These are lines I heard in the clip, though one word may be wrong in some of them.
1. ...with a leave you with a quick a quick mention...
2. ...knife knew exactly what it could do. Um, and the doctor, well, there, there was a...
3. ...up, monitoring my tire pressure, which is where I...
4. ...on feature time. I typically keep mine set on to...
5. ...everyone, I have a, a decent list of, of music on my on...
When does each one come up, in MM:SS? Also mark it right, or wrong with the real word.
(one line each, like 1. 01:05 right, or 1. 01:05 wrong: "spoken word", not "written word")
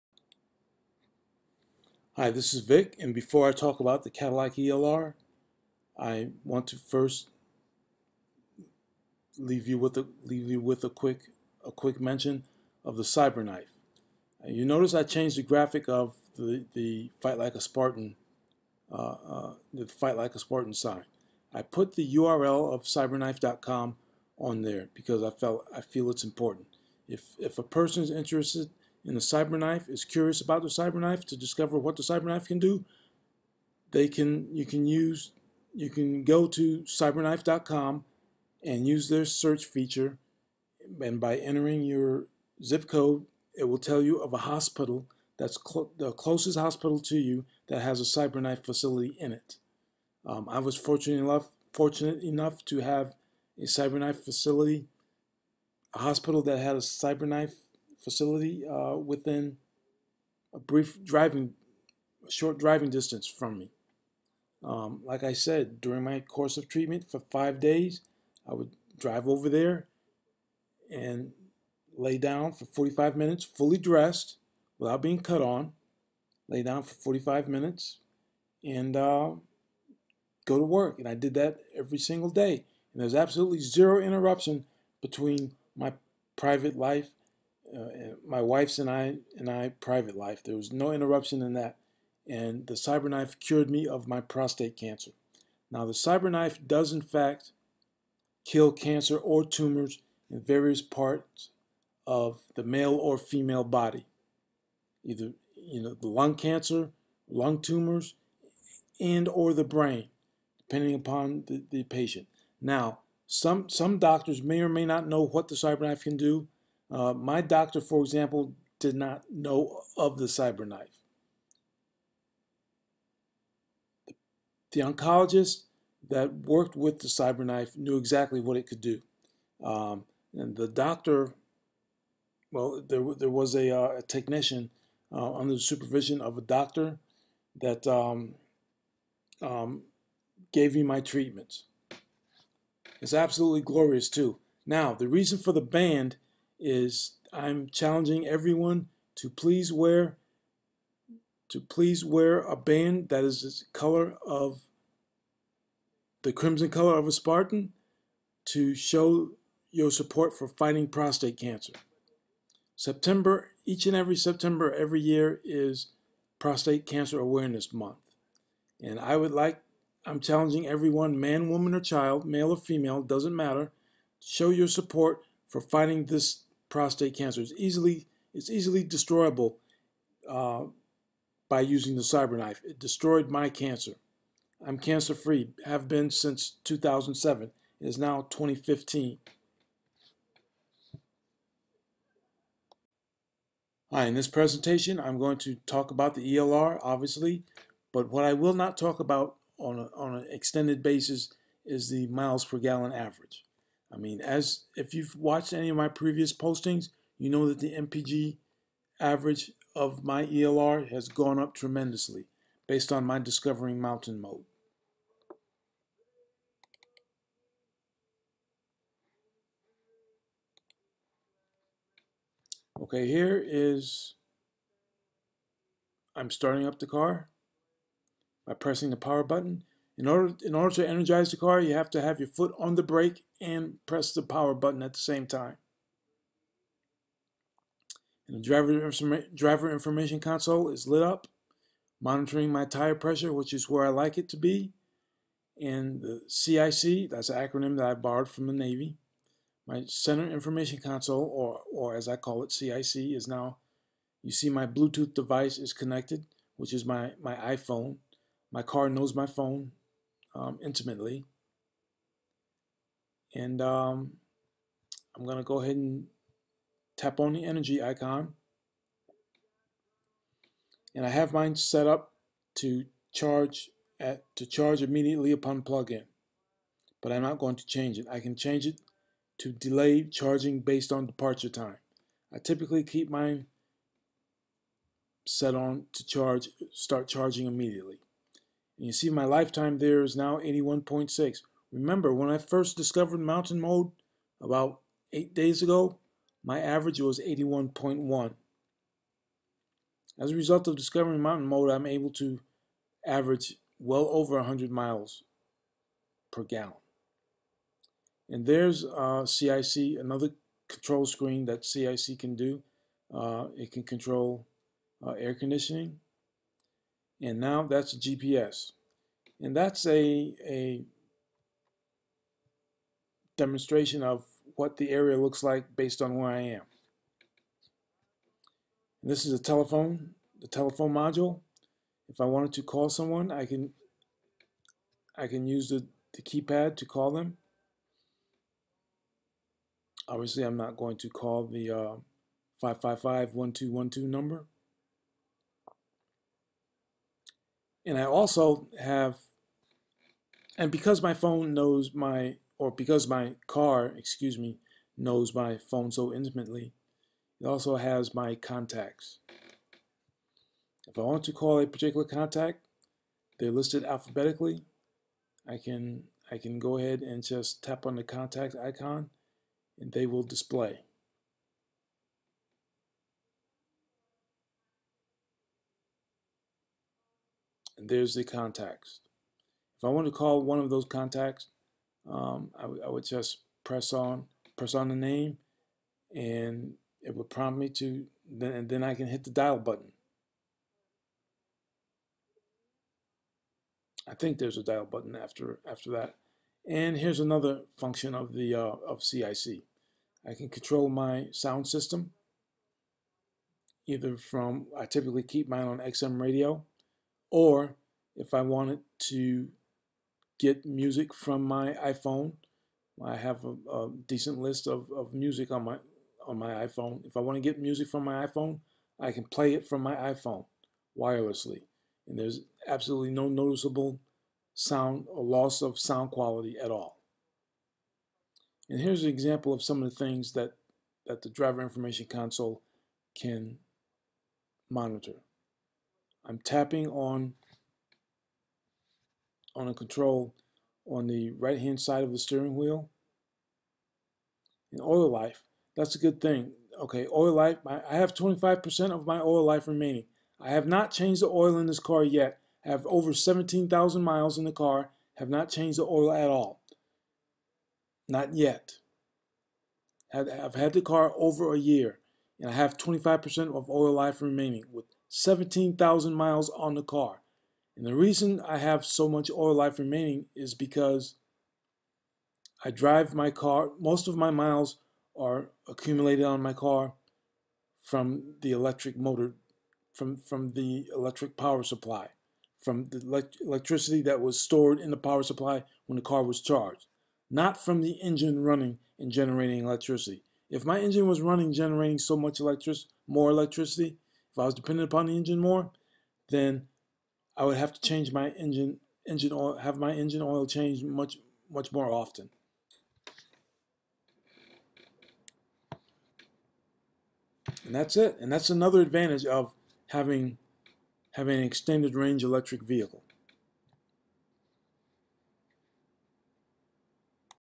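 1. 00:09 right
2. 02:07 right
3. 04:01 right
4. 04:40 wrong: "departure", not "feature"
5. 06:51 wrong: "iPhone", not "everyone".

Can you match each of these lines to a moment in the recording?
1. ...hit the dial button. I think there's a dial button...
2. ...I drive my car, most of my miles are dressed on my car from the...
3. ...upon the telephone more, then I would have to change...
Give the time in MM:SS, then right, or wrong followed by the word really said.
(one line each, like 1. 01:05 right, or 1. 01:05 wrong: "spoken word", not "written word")
1. 06:29 right
2. 07:52 wrong: "accumulated", not "dressed"
3. 08:14 wrong: "engine", not "telephone".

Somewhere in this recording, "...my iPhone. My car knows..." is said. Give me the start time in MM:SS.
04:17.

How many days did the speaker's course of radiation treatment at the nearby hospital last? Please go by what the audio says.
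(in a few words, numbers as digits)
5 days.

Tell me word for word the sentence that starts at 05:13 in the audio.
Uh, it can control uh, air conditioning.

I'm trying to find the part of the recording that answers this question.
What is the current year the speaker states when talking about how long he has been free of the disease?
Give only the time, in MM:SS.
03:08.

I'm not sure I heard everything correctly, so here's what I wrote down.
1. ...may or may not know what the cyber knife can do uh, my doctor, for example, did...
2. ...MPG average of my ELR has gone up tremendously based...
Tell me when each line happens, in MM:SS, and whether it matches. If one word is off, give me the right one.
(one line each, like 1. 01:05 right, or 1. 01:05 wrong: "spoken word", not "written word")
1. 01:54 right
2. 03:27 right.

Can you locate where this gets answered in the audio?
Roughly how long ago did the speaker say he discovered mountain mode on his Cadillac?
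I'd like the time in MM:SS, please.
04:55.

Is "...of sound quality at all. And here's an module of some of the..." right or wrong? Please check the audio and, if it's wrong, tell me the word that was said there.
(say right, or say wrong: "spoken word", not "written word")
wrong: "example", not "module".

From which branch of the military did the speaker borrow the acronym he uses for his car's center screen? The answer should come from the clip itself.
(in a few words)
the Navy.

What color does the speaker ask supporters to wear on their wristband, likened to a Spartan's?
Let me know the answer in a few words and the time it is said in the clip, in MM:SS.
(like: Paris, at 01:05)
crimson, at 02:36.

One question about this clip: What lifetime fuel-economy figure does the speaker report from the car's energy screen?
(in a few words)
81.6.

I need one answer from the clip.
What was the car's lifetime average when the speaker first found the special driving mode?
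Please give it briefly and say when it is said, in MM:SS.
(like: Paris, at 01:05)
81.1, at 04:57.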